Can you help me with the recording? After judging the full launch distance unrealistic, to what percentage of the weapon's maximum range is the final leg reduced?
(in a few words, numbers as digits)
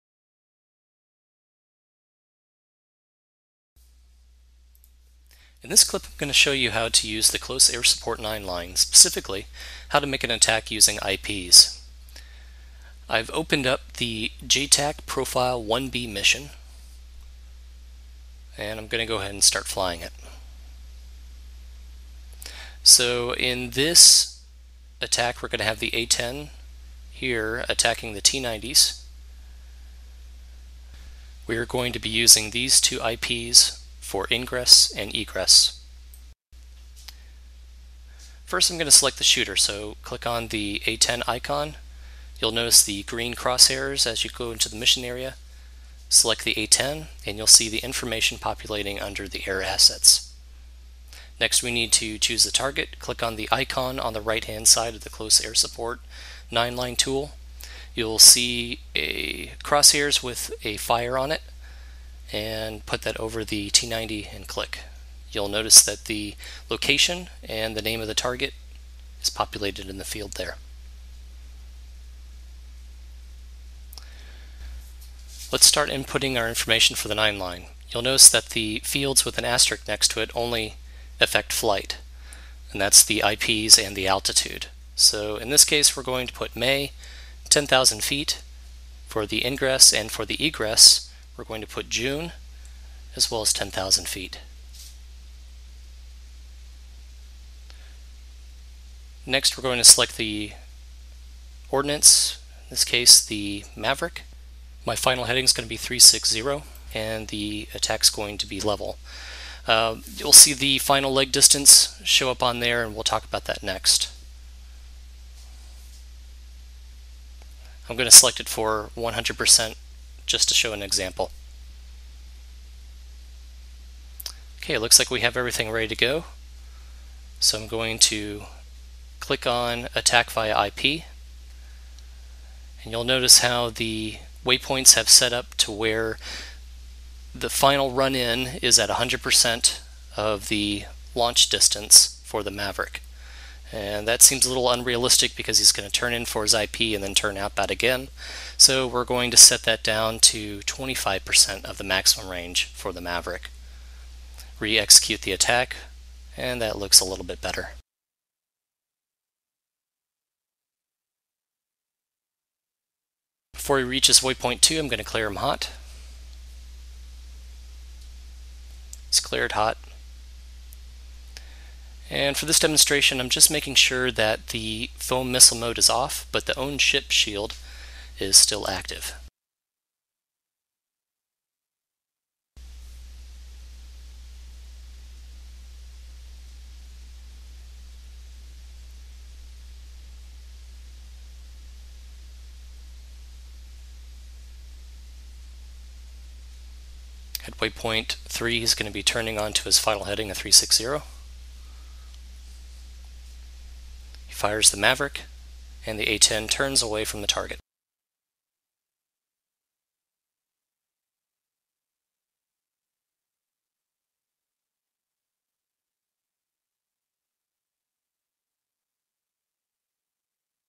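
25%.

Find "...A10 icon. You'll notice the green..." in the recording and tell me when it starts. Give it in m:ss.
0:40.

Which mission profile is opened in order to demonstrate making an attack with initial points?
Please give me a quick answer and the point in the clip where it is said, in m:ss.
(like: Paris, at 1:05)
JTAC Profile 1B, at 0:14.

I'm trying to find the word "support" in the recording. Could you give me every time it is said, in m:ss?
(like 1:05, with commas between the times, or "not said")
0:07, 0:55.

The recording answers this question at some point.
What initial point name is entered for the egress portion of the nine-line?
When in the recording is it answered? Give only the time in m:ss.
1:31.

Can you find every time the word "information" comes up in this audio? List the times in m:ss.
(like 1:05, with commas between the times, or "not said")
0:47, 1:16.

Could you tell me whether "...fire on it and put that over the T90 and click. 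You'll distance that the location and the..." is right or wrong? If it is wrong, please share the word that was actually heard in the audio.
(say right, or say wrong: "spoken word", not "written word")
wrong: "notice", not "distance".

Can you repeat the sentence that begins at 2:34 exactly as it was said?
Re-execute the attack, and that looks a little bit better.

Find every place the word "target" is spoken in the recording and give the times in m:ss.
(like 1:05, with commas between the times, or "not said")
0:52, 1:08, 3:27.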